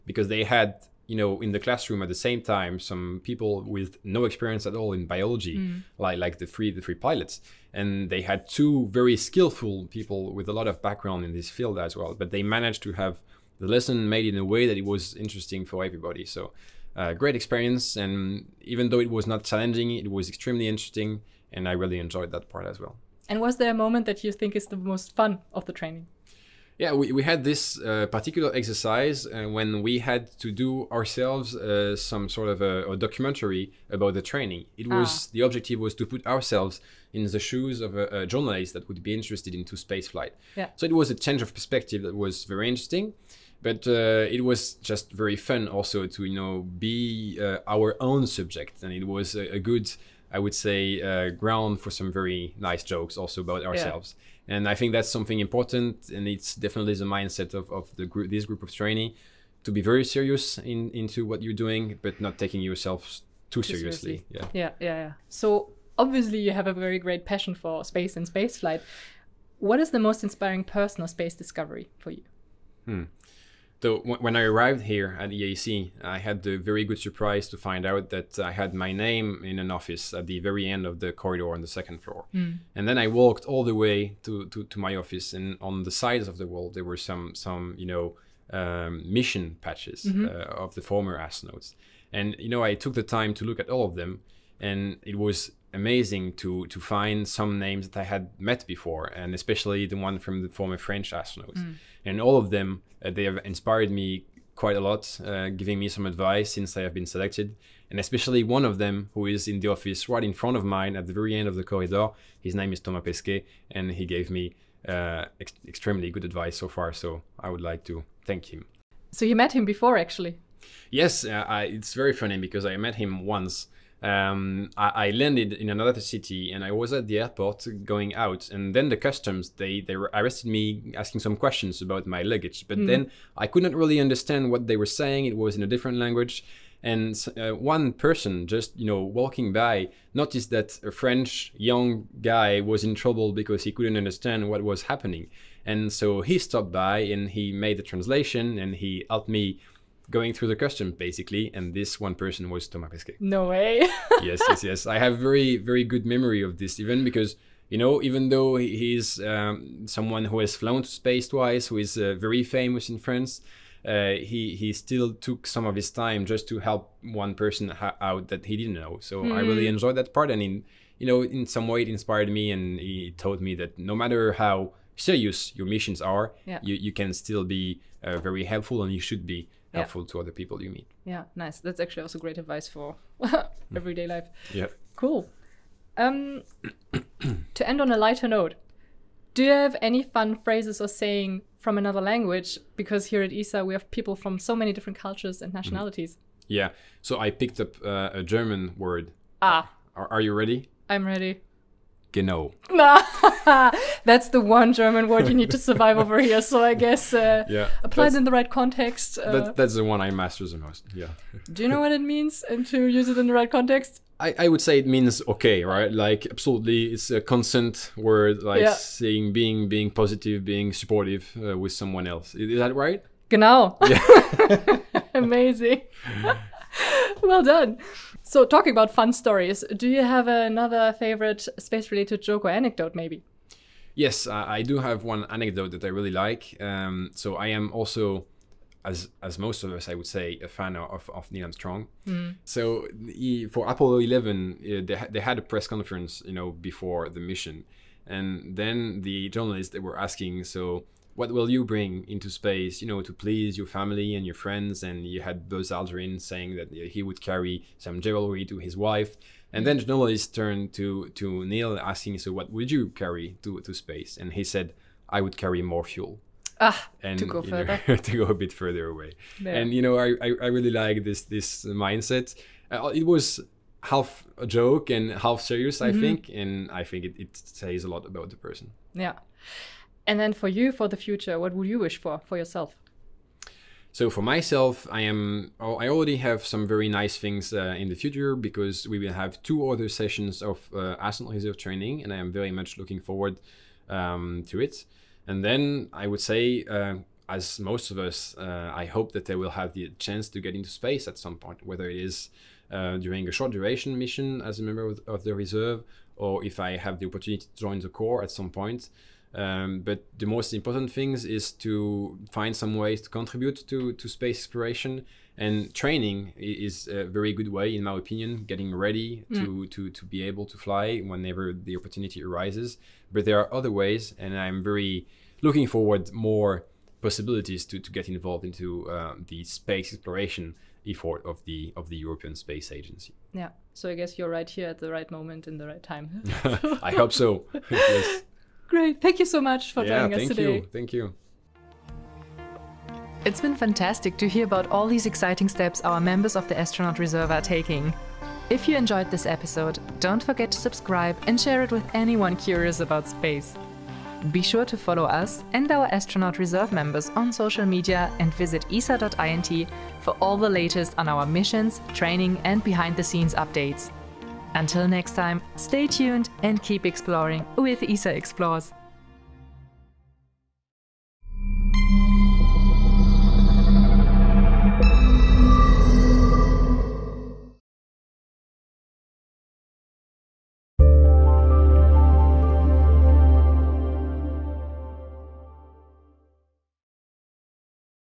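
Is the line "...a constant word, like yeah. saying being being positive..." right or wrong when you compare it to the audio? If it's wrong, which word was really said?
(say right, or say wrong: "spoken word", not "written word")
right.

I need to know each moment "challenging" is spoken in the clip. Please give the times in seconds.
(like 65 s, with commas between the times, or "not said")
19 s.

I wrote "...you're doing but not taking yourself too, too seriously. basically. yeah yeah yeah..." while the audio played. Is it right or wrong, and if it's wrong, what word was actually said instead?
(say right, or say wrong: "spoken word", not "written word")
wrong: "seriously", not "basically".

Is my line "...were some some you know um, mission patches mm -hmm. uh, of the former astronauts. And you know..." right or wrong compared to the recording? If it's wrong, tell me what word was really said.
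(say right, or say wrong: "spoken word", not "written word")
right.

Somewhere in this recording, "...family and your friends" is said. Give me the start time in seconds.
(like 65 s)
253 s.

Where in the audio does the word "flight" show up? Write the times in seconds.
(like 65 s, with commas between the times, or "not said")
40 s, 68 s.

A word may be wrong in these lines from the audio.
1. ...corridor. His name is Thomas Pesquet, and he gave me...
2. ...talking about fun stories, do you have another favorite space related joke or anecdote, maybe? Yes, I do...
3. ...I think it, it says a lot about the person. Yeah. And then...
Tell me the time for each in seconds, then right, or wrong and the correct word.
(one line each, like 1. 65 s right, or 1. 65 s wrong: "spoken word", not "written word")
1. 111 s right
2. 228 s right
3. 276 s right.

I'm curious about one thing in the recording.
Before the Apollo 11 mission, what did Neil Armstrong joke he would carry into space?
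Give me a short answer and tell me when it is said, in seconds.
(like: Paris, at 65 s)
more fuel, at 265 s.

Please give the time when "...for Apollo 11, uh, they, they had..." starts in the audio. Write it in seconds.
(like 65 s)
243 s.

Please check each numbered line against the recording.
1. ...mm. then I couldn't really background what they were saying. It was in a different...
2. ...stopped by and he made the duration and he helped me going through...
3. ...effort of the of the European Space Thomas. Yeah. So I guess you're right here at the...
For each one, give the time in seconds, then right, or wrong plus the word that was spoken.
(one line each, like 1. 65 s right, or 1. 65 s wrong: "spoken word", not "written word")
1. 132 s wrong: "understand", not "background"
2. 146 s wrong: "translation", not "duration"
3. 330 s wrong: "Agency", not "Thomas".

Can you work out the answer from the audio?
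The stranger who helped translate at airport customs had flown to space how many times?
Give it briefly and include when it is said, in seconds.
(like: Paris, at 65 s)
2, at 161 s.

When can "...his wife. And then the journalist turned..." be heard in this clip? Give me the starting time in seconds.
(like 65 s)
258 s.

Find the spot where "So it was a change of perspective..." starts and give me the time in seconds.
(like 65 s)
40 s.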